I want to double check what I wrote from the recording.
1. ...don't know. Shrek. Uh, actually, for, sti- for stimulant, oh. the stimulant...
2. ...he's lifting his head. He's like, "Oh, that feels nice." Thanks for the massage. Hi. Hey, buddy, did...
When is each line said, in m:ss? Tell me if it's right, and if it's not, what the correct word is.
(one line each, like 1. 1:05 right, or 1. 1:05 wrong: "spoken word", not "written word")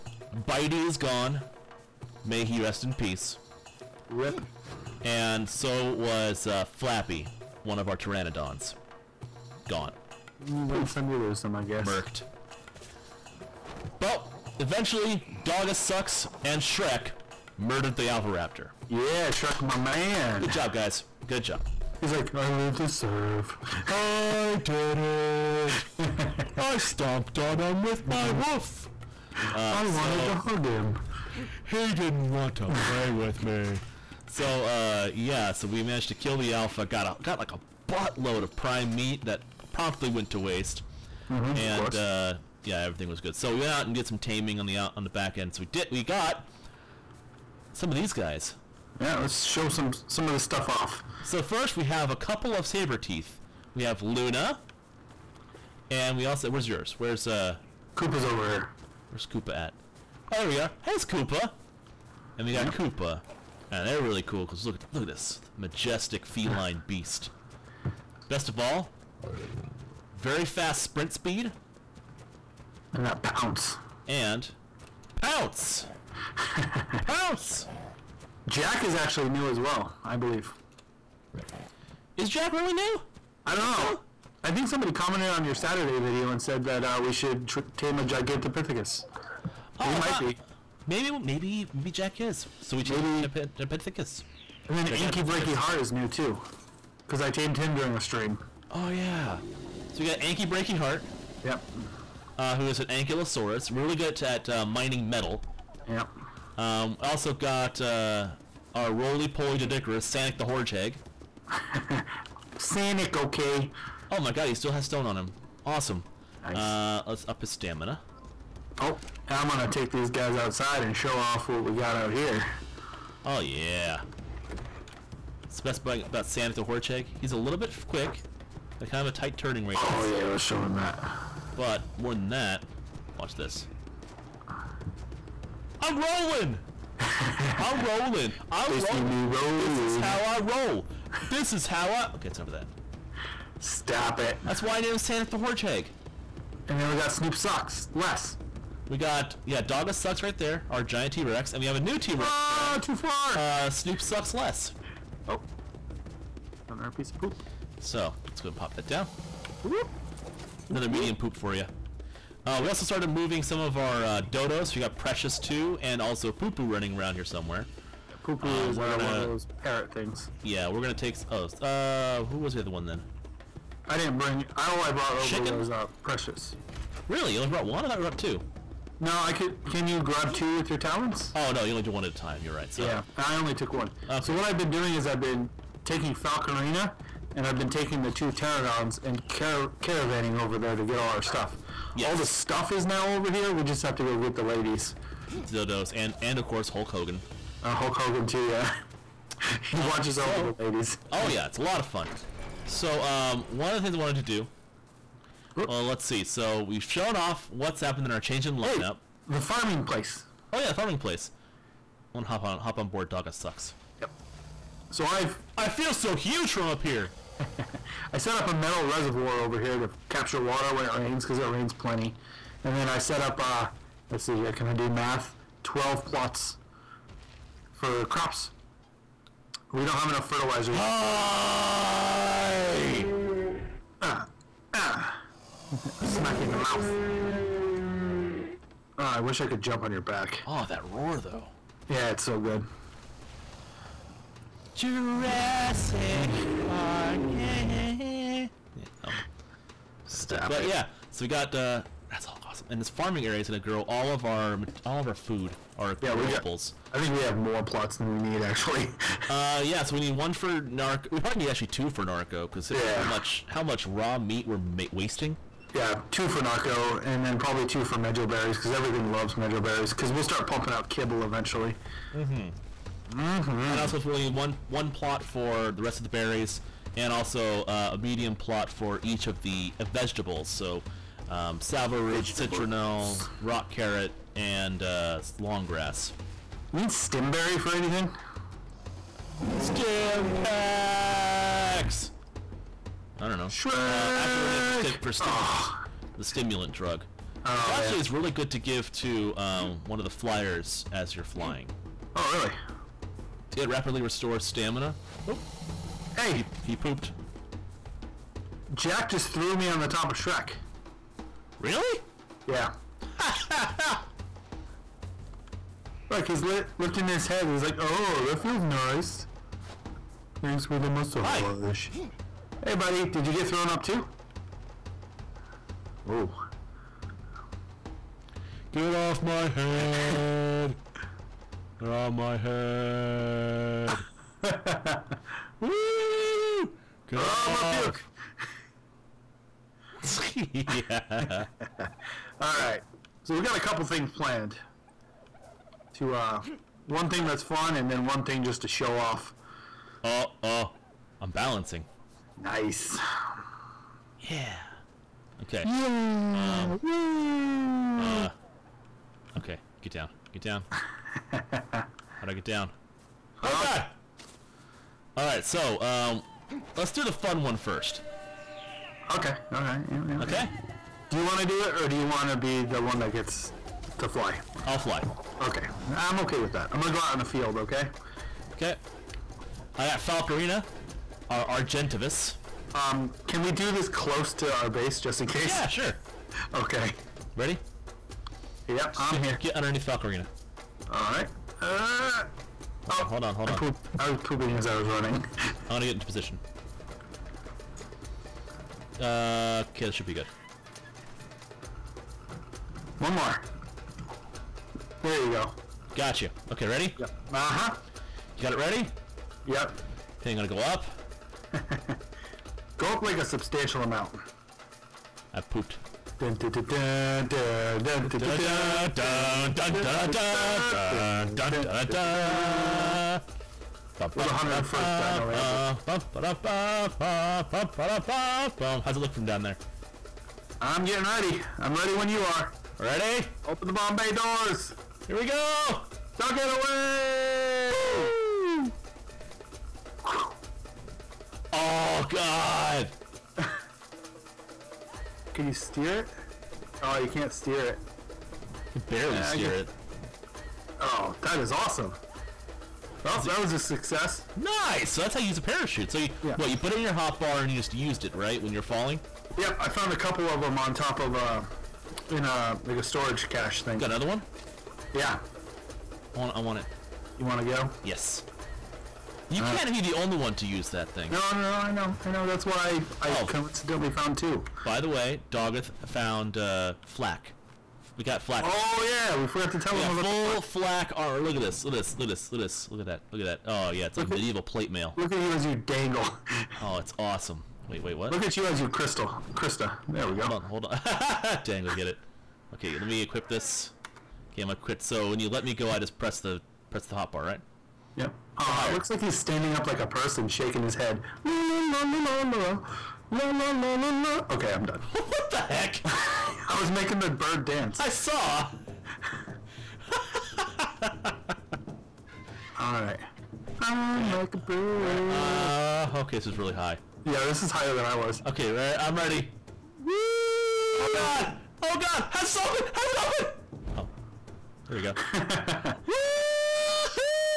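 1. 4:53 right
2. 5:16 right.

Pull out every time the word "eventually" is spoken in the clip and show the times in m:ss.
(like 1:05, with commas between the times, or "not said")
0:14, 4:31.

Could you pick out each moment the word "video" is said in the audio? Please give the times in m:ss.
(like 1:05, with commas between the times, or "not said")
1:25.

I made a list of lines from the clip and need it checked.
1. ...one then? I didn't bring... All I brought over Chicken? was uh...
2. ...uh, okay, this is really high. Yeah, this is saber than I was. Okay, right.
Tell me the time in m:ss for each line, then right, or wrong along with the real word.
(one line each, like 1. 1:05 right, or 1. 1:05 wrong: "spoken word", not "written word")
1. 2:52 right
2. 8:35 wrong: "higher", not "saber".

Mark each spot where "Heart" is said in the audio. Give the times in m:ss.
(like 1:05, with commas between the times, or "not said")
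1:35, 1:40.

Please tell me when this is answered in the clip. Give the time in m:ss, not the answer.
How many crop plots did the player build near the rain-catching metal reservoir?
3:45.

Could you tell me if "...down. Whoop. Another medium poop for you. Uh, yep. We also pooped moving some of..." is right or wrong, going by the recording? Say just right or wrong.
wrong.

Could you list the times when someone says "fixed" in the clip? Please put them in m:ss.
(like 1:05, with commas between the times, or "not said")
not said.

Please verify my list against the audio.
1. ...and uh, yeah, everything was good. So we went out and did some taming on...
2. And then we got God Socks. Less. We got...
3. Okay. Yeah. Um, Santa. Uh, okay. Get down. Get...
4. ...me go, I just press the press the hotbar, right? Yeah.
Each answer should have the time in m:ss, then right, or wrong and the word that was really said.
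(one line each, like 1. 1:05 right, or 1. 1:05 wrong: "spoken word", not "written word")
1. 0:41 right
2. 2:26 wrong: "Snoop", not "God"
3. 5:55 wrong: "Woo", not "Santa"
4. 8:15 right.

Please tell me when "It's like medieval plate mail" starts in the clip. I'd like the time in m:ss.
8:03.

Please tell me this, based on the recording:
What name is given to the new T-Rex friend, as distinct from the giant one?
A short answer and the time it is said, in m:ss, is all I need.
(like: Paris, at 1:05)
Snoop Sucks Less, at 2:33.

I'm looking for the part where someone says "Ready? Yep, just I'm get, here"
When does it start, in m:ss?
6:27.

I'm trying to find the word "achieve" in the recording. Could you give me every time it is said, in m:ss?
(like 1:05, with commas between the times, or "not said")
not said.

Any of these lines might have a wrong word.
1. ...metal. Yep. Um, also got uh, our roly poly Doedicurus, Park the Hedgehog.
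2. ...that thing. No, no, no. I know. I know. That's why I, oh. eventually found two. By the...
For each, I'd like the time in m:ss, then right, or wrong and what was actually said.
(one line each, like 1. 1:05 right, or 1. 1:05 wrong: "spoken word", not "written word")
1. 1:45 wrong: "Sanic", not "Park"
2. 7:50 wrong: "coincidentally", not "eventually".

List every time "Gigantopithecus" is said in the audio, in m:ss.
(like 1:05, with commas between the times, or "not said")
1:28, 1:33.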